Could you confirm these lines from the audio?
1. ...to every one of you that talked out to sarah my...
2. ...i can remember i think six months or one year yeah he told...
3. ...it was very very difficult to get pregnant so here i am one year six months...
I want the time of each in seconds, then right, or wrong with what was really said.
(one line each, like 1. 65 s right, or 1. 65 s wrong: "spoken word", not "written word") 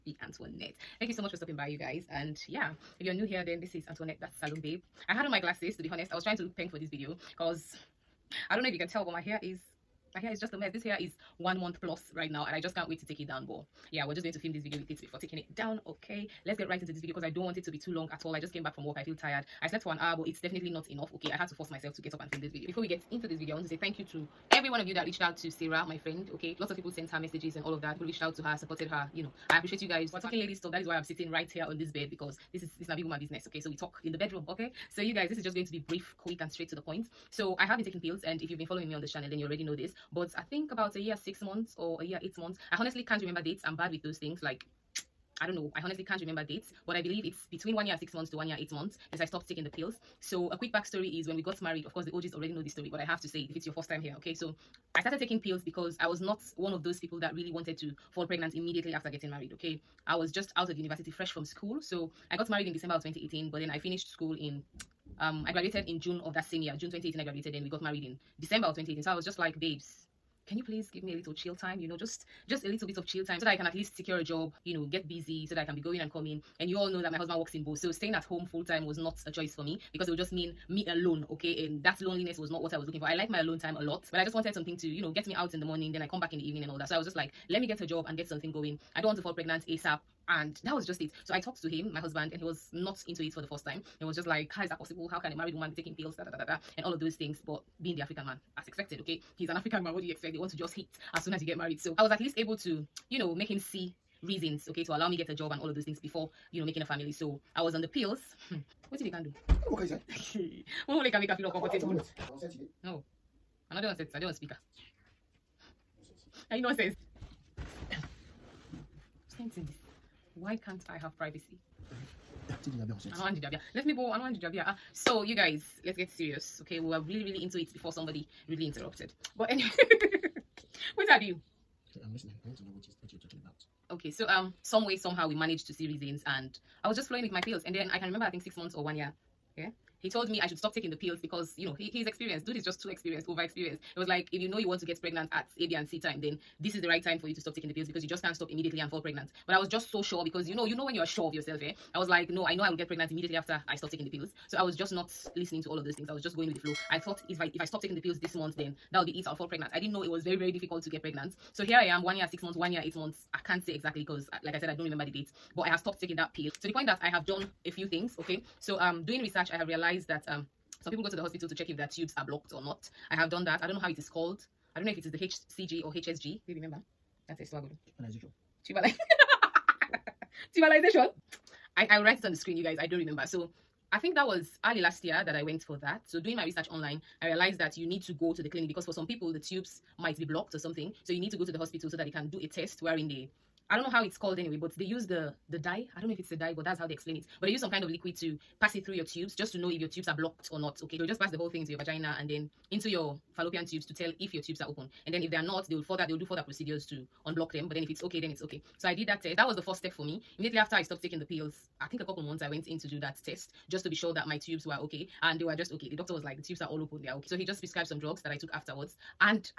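1. 24 s wrong: "reached", not "talked"
2. 137 s right
3. 160 s right.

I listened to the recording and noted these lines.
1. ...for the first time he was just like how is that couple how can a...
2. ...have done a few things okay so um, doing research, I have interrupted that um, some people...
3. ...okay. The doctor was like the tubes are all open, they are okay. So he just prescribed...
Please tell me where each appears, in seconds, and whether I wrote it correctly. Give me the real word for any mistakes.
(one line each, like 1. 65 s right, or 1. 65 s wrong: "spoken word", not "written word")
1. 93 s wrong: "possible", not "couple"
2. 167 s wrong: "realized", not "interrupted"
3. 215 s right.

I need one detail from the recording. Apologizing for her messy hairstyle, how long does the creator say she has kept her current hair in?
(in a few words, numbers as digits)
One month plus.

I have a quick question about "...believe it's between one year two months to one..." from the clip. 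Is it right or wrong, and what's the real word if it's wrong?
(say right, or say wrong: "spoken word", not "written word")
wrong: "six", not "two".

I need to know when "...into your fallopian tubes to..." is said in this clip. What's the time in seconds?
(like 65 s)
202 s.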